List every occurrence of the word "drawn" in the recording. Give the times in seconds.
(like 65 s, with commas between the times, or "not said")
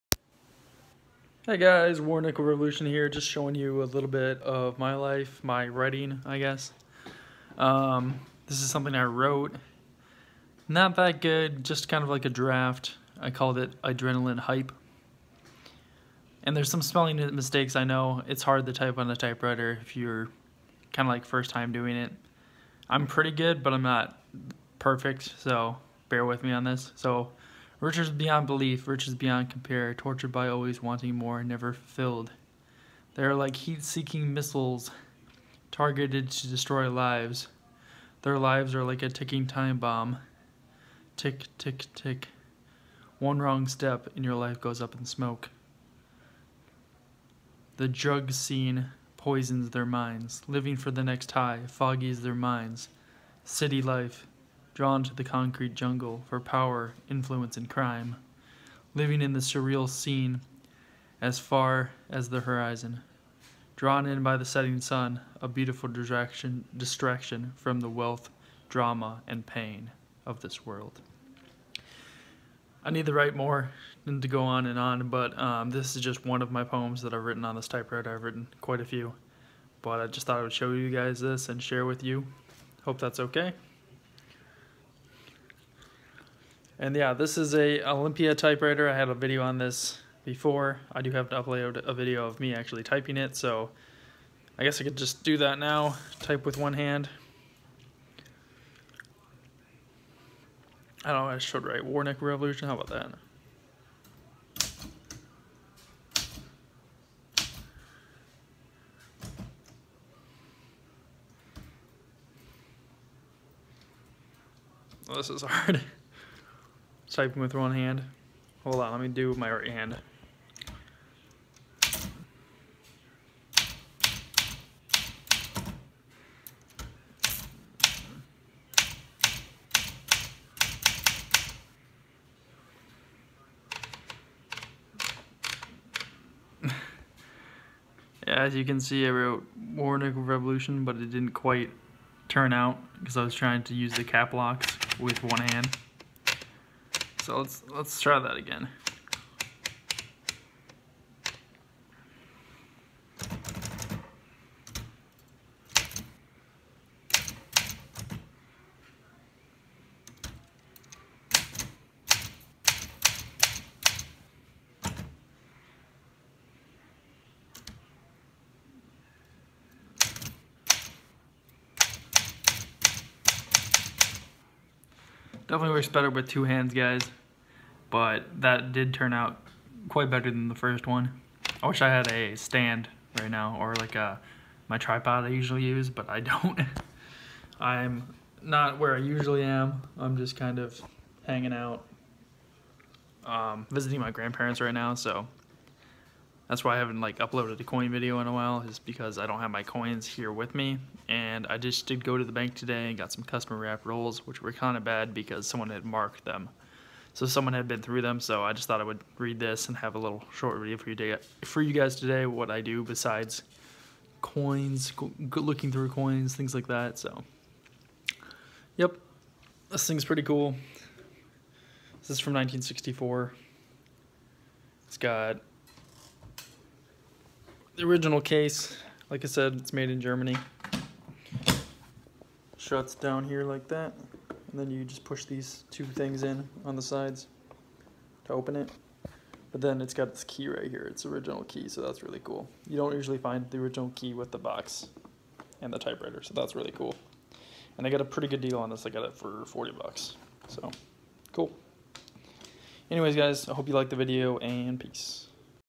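54 s, 63 s.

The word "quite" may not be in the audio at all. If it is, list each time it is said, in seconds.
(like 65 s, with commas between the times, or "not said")
78 s, 141 s, 179 s.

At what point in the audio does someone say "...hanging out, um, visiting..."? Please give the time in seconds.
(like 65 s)
191 s.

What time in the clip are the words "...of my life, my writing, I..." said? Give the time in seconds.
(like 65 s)
4 s.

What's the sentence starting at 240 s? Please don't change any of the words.
It's original key, so that's really cool.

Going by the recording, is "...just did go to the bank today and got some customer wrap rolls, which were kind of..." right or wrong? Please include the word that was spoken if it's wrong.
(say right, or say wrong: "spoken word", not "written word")
right.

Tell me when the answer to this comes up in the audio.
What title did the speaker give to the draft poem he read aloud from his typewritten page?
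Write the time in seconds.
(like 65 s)
13 s.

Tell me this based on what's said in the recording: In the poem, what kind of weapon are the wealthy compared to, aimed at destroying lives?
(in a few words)
heat seeking missiles.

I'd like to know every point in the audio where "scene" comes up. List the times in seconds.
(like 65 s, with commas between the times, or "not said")
48 s, 59 s.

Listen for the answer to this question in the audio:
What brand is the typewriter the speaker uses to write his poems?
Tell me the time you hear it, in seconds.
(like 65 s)
87 s.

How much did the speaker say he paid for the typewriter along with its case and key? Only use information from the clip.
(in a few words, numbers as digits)
$40.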